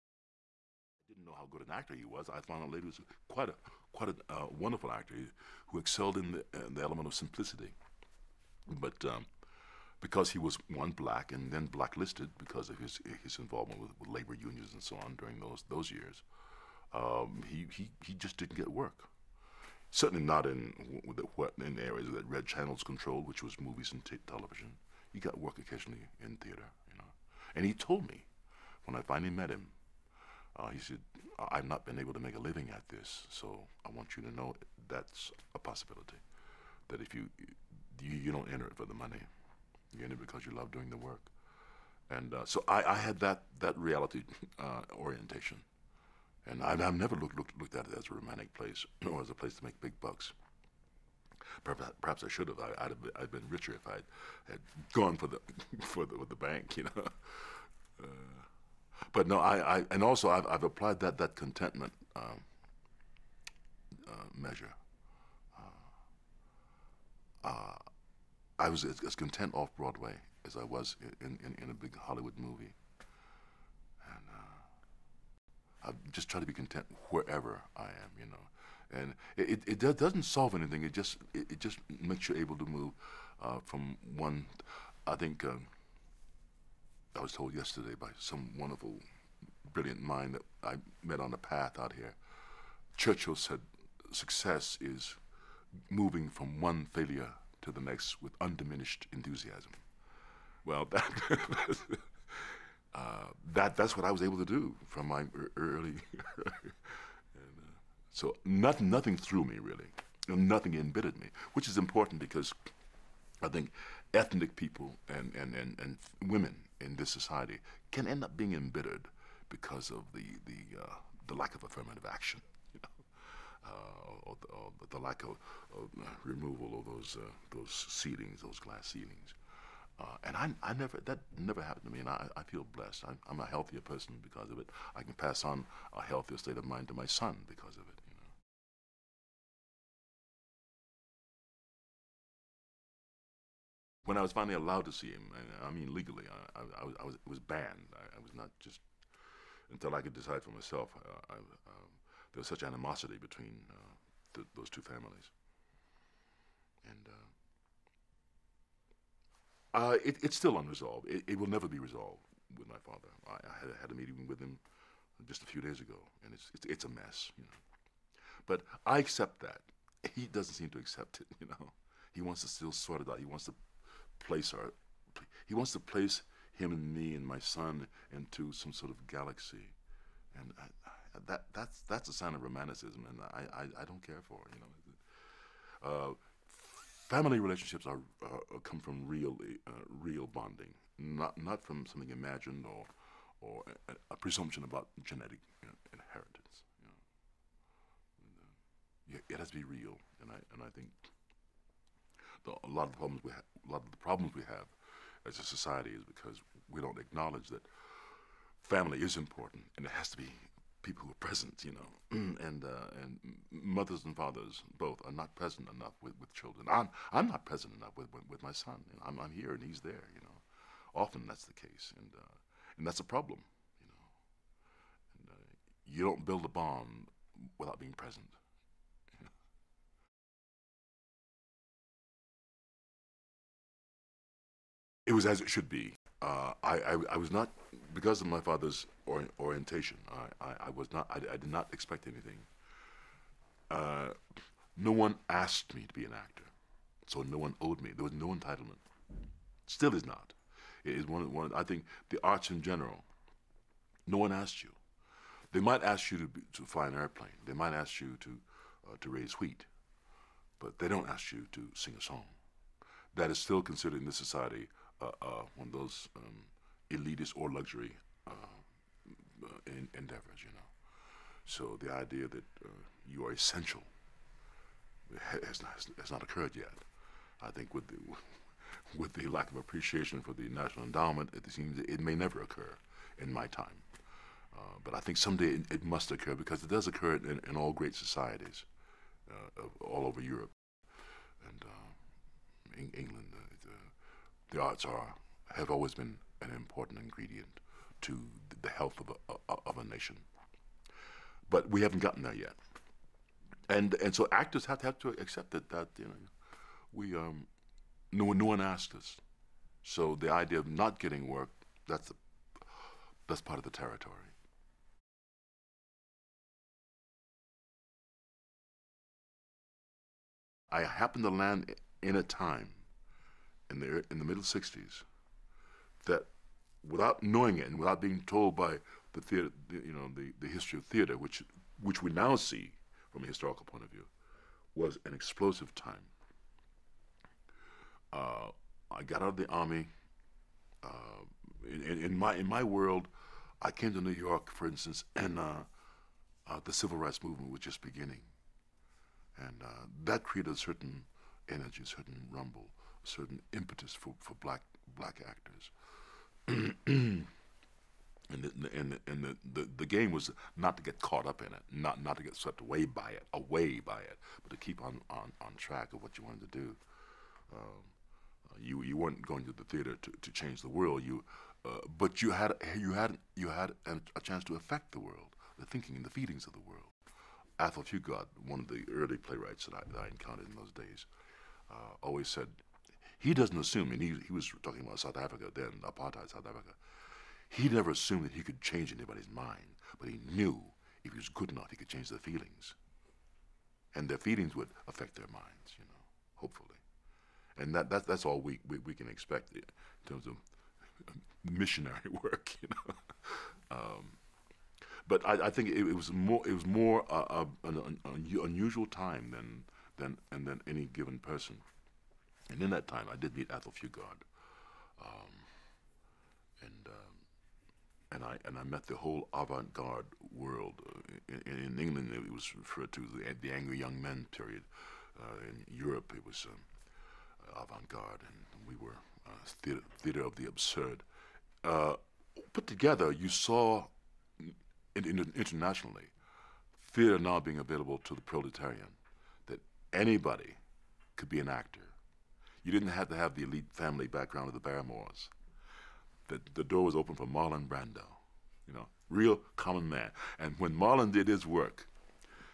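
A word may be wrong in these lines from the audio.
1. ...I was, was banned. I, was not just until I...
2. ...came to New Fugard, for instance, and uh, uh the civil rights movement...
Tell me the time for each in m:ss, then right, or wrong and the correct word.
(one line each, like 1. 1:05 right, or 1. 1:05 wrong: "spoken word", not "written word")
1. 2:26 right
2. 5:43 wrong: "York", not "Fugard".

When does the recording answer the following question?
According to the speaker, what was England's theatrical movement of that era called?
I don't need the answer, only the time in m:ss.
7:03.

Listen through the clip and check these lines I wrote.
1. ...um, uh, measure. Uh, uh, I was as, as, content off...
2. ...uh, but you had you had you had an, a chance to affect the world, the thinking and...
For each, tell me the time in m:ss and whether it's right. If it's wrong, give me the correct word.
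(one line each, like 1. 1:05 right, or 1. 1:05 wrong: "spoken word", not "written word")
1. 1:02 right
2. 6:11 right.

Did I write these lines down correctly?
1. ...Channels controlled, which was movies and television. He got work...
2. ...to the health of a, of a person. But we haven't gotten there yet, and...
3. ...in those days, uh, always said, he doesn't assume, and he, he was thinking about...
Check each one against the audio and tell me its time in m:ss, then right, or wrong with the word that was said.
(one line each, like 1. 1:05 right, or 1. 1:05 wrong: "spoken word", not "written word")
1. 0:22 right
2. 4:58 wrong: "nation", not "person"
3. 6:20 wrong: "talking", not "thinking".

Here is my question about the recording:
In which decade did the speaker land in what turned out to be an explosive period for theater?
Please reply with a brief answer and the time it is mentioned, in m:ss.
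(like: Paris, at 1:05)
The '60s, at 5:24.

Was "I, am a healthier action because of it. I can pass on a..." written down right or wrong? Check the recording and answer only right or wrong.
wrong.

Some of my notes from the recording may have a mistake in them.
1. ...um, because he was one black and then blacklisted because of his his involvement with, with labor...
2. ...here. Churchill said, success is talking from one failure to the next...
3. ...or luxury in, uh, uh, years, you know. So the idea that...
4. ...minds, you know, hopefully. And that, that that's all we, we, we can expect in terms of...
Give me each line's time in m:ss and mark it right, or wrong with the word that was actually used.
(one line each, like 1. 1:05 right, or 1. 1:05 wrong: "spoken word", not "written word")
1. 0:09 right
2. 1:31 wrong: "moving", not "talking"
3. 4:27 wrong: "endeavors", not "years"
4. 6:35 right.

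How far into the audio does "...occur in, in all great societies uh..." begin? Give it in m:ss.
4:46.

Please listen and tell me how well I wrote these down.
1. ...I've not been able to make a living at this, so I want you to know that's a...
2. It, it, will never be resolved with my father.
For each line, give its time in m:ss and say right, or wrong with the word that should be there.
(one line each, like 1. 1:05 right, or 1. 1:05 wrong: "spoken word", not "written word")
1. 0:31 right
2. 2:41 right.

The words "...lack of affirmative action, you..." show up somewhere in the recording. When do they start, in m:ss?
2:01.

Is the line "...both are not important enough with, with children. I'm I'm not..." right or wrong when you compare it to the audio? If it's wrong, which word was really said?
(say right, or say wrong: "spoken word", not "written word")
wrong: "present", not "important".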